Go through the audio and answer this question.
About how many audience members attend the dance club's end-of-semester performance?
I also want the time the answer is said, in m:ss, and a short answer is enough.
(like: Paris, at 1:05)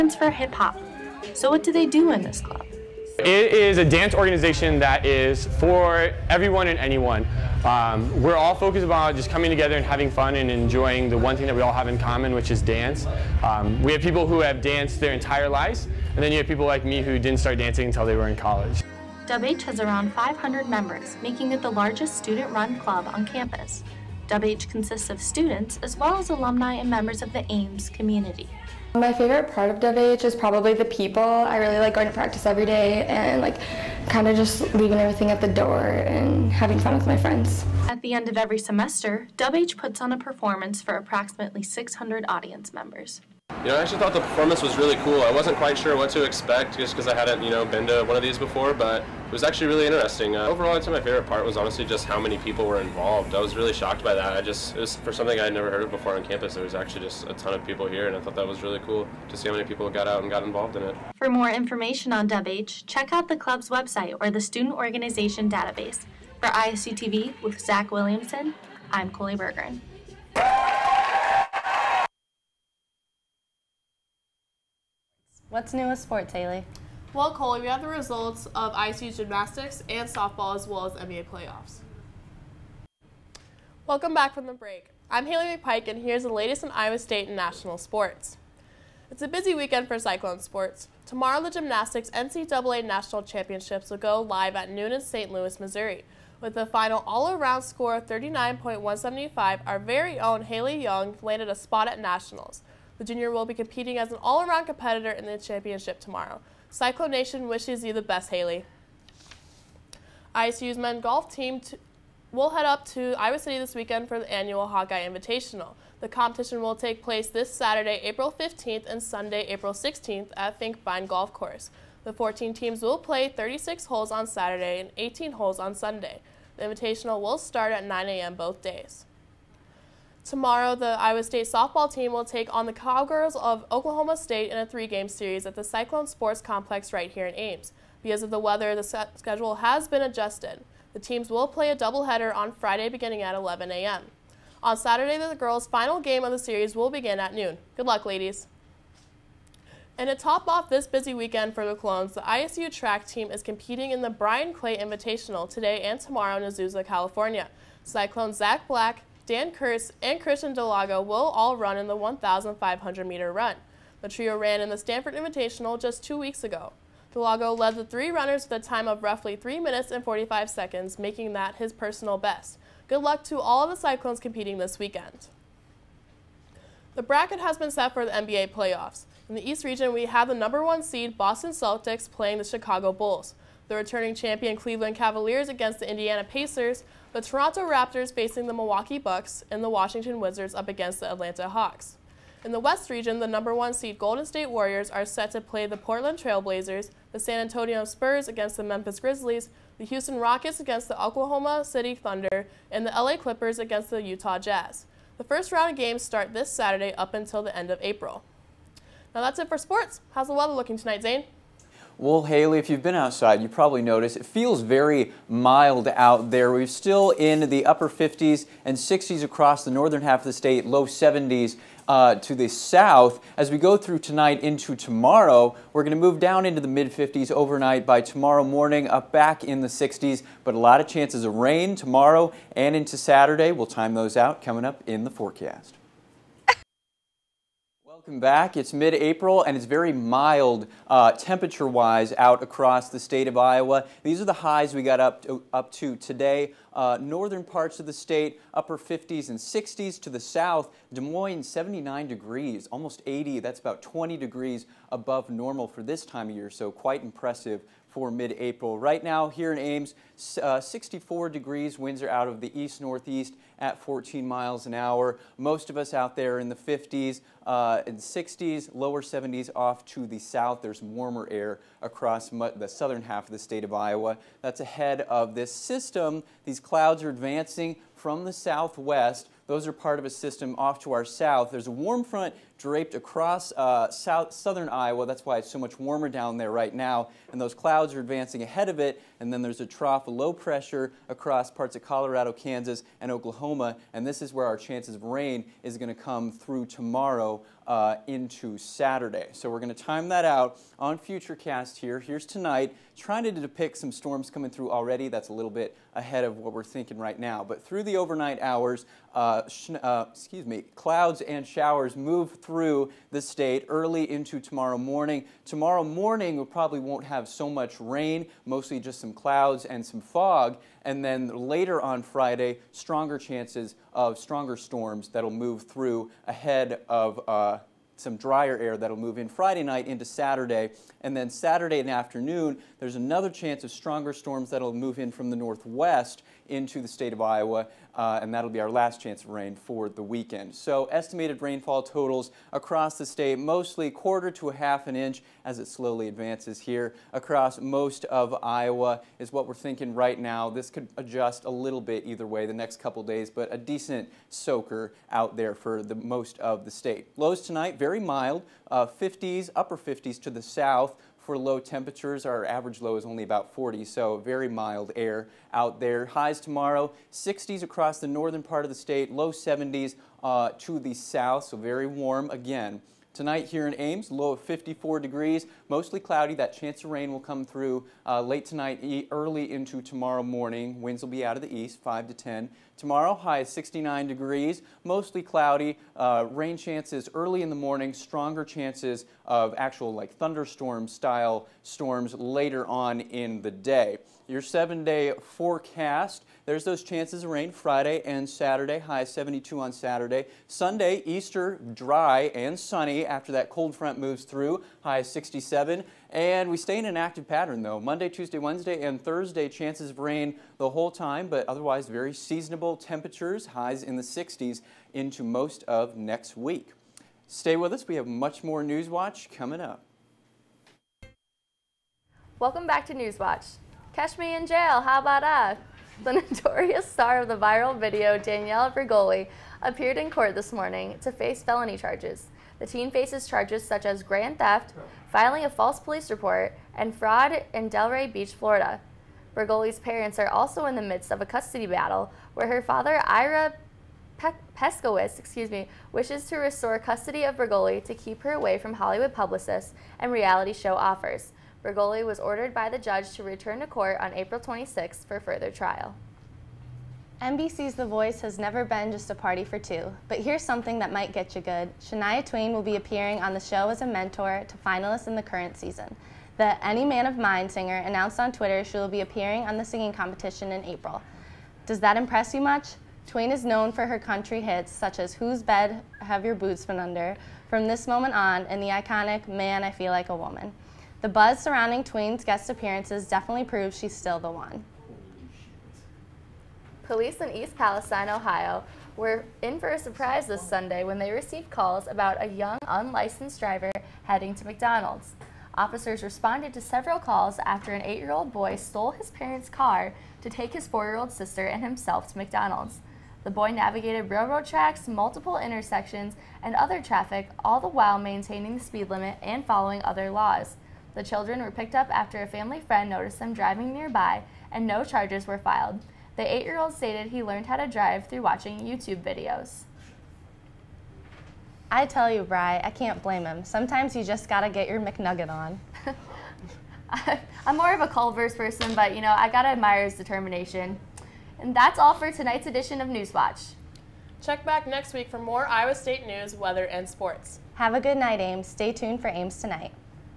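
600, at 0:40.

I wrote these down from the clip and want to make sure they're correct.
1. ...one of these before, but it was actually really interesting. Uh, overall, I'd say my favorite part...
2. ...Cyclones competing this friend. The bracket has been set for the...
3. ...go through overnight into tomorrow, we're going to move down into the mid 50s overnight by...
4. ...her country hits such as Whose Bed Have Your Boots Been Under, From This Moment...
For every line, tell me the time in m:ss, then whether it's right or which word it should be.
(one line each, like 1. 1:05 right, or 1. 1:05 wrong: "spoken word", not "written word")
1. 0:48 right
2. 2:53 wrong: "weekend", not "friend"
3. 3:43 wrong: "tonight", not "overnight"
4. 7:53 right.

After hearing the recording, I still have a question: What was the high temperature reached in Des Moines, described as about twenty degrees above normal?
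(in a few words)
79 degrees.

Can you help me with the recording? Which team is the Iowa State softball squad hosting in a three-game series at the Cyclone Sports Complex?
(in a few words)
Oklahoma State.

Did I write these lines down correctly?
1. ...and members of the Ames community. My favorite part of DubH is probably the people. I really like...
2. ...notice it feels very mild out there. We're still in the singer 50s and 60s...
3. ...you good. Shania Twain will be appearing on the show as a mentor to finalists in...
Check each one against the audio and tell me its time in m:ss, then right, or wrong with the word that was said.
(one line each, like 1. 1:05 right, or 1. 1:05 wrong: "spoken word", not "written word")
1. 0:26 right
2. 3:33 wrong: "upper", not "singer"
3. 7:41 right.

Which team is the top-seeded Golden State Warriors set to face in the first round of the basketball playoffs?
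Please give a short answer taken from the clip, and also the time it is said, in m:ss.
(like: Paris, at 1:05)
Portland Trailblazers, at 3:15.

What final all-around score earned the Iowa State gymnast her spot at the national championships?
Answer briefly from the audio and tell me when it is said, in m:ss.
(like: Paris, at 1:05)
39.175, at 1:38.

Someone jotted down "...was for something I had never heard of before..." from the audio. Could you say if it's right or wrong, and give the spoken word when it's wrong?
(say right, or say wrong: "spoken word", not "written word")
right.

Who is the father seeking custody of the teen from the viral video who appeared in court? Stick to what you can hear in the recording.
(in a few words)
Ira Peskowitz.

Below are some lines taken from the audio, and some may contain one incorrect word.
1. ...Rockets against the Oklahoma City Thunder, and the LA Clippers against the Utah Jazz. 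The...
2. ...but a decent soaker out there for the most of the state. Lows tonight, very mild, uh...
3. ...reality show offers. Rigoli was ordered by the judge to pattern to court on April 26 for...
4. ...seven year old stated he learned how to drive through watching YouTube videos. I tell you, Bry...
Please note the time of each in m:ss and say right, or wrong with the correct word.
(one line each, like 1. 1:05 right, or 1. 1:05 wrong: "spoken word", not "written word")
1. 3:20 right
2. 5:53 right
3. 7:30 wrong: "return", not "pattern"
4. 8:36 wrong: "eight", not "seven".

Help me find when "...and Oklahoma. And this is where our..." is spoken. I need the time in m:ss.
4:52.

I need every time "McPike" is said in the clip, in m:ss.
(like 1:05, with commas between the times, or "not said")
1:25.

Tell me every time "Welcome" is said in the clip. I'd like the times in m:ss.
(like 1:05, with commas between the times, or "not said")
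1:23, 3:57, 7:02.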